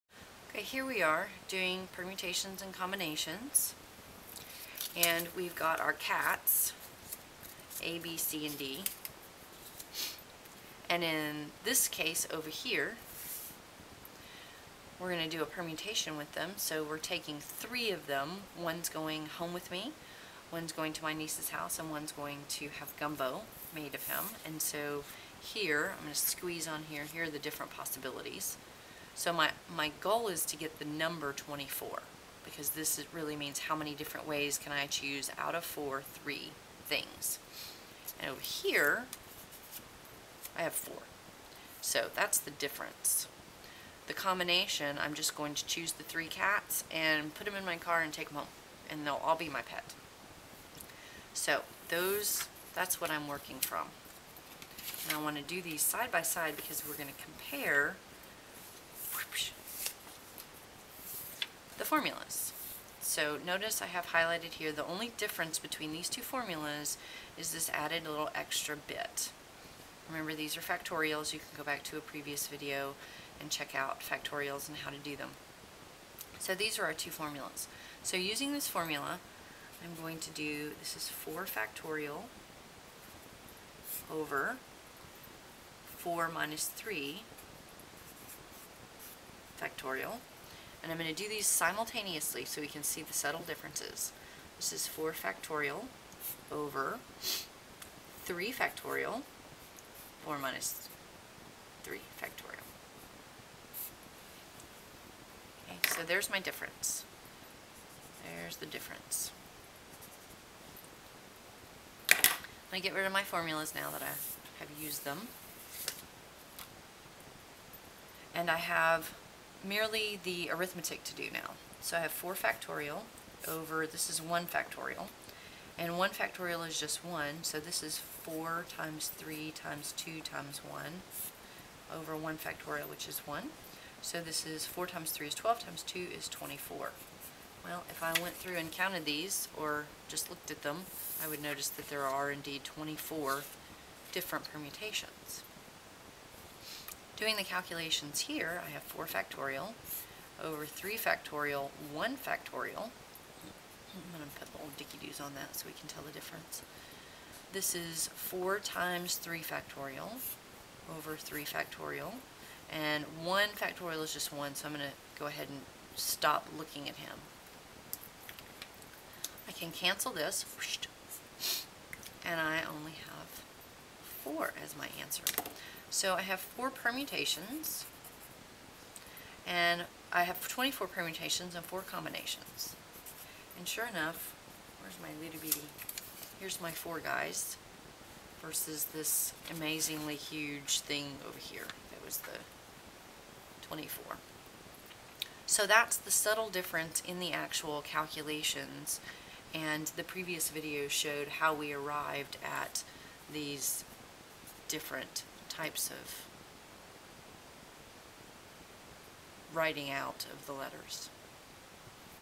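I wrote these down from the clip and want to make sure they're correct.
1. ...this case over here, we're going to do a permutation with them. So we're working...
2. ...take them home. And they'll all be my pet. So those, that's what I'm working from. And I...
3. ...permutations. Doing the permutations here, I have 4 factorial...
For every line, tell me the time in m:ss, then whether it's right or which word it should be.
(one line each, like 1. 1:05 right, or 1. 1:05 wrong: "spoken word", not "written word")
1. 0:11 wrong: "taking", not "working"
2. 0:48 right
3. 2:24 wrong: "calculations", not "permutations".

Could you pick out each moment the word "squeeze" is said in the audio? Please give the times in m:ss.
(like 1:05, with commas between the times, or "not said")
0:26.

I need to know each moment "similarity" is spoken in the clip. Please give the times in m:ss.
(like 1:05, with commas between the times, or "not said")
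not said.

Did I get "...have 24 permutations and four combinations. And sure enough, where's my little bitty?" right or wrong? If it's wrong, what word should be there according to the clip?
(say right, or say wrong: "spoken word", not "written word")
right.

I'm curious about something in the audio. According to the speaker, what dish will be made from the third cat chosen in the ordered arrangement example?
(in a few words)
Gumbo.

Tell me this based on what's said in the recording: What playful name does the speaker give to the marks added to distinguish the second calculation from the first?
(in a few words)
Dicky-doos.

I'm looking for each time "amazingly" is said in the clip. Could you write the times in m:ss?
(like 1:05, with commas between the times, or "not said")
3:09.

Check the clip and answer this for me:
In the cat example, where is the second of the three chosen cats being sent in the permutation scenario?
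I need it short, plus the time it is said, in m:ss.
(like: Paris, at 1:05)
My niece's house, at 0:21.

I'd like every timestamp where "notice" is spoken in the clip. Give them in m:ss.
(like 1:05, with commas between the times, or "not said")
1:03, 2:21.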